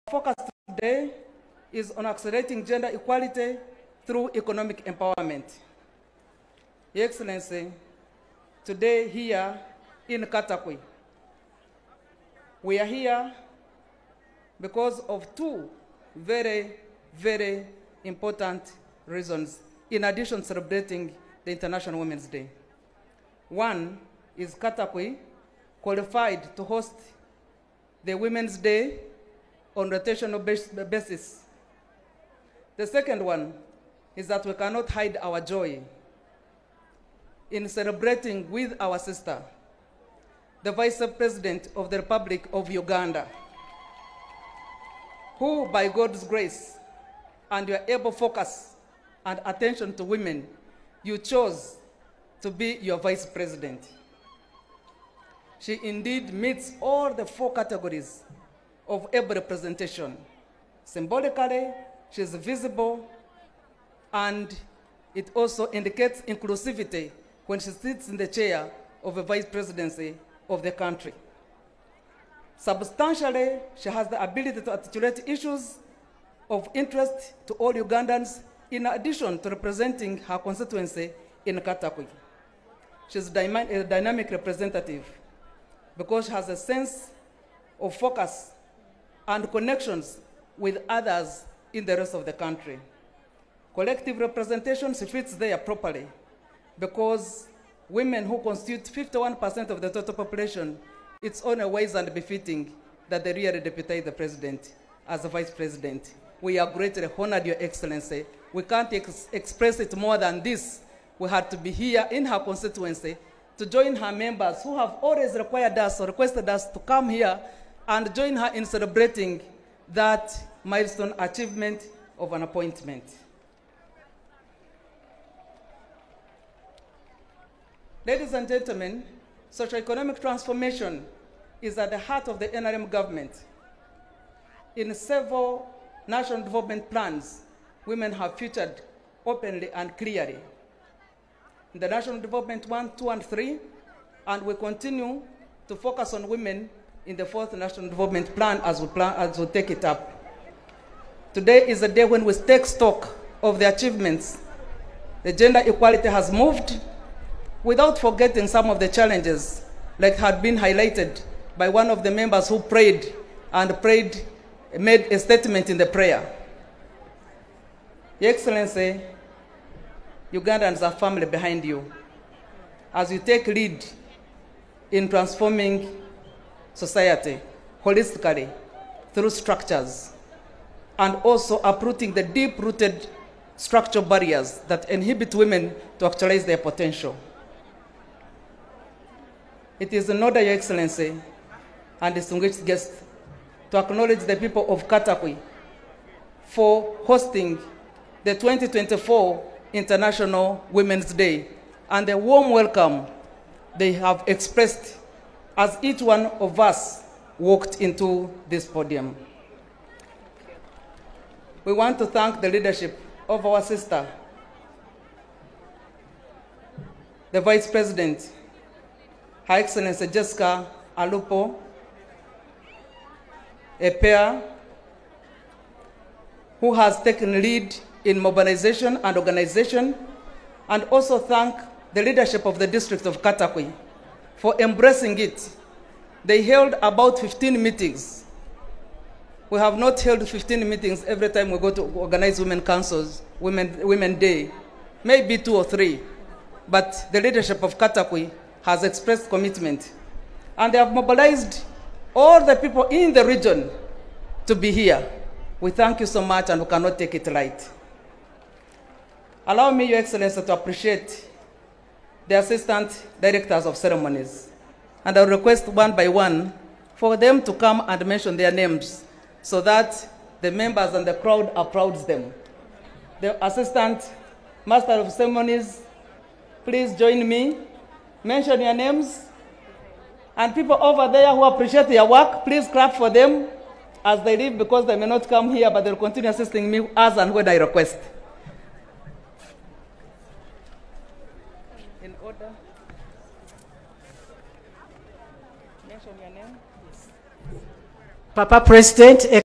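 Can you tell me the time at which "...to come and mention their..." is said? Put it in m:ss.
4:27.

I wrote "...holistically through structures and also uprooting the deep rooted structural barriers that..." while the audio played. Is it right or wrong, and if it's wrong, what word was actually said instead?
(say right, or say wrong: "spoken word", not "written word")
right.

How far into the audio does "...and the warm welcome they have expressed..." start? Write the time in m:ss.
3:21.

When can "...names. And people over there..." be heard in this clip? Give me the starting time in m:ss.
4:38.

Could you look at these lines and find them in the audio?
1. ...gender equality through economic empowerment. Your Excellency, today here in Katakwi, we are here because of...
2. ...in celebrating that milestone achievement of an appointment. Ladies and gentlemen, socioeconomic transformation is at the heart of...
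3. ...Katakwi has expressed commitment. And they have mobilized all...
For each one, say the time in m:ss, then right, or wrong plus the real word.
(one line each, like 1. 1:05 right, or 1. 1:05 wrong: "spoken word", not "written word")
1. 0:02 right
2. 1:58 right
3. 4:07 right.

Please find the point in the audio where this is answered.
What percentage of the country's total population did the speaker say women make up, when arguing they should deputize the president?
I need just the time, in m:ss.
1:38.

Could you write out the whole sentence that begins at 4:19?
Allow me, Your Excellency, to appreciate the assistant directors of ceremonies.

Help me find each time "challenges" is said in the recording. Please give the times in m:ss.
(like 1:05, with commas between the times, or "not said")
2:38.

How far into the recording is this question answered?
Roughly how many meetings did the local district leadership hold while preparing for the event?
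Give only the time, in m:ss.
3:56.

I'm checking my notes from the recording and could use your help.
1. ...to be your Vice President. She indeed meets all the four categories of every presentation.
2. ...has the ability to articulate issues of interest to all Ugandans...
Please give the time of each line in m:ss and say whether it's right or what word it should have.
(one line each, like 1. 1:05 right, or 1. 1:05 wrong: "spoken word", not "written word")
1. 0:52 right
2. 1:13 right.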